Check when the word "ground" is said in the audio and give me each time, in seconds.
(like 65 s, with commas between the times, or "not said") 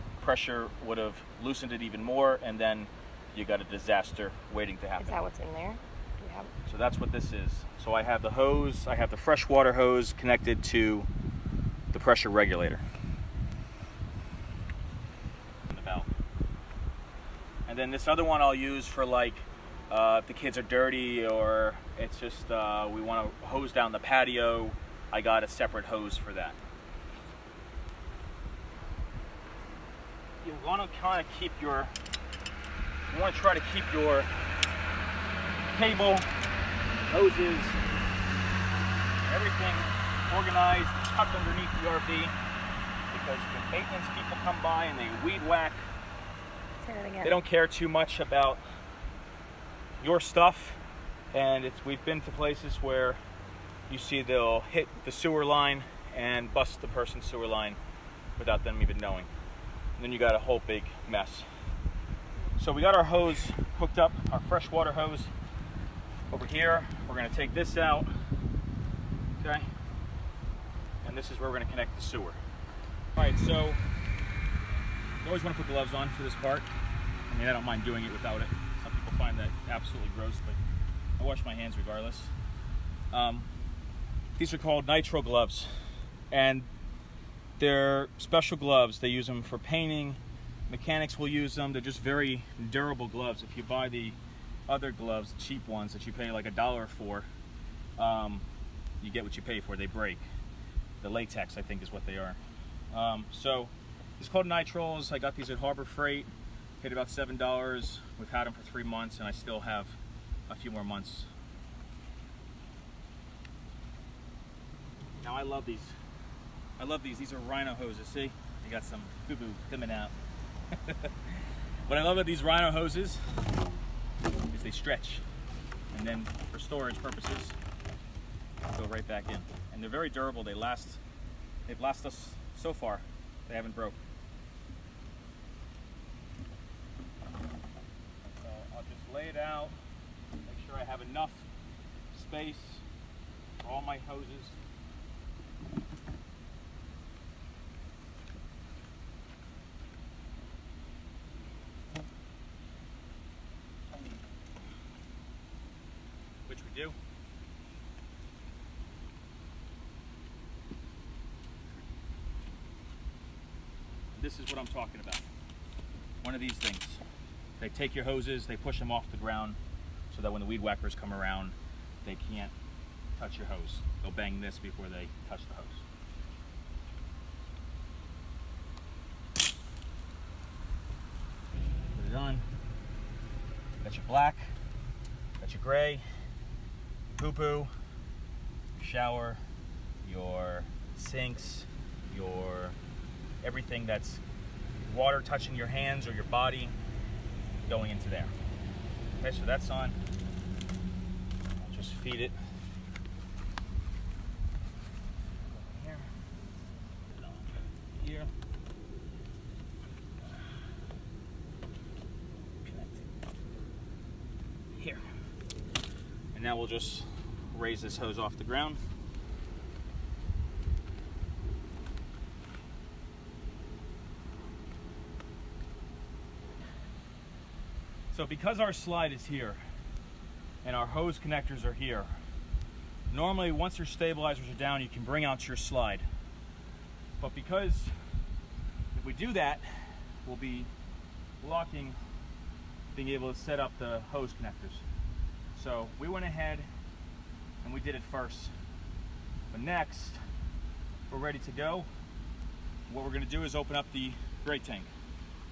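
169 s, 218 s.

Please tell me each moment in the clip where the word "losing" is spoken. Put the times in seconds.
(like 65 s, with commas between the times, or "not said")
not said.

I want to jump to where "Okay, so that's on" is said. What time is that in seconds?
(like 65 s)
199 s.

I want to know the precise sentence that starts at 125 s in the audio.
And then for storage purposes, go right back in.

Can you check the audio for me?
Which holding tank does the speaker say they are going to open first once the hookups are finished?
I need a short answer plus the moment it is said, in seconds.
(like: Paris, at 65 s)
gray tank, at 254 s.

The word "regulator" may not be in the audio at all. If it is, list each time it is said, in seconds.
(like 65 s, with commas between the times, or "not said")
12 s.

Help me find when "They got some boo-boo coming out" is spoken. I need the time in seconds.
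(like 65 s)
118 s.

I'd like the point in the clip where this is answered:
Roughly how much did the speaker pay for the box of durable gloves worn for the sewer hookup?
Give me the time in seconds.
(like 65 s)
107 s.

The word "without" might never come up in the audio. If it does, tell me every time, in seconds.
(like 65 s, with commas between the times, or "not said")
58 s, 78 s.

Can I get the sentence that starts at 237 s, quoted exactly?
But because if we do that, we'll be blocking being able to set up the hose connectors.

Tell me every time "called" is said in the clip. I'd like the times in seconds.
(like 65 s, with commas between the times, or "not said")
84 s, 104 s.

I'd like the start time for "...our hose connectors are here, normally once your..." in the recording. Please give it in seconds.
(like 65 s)
230 s.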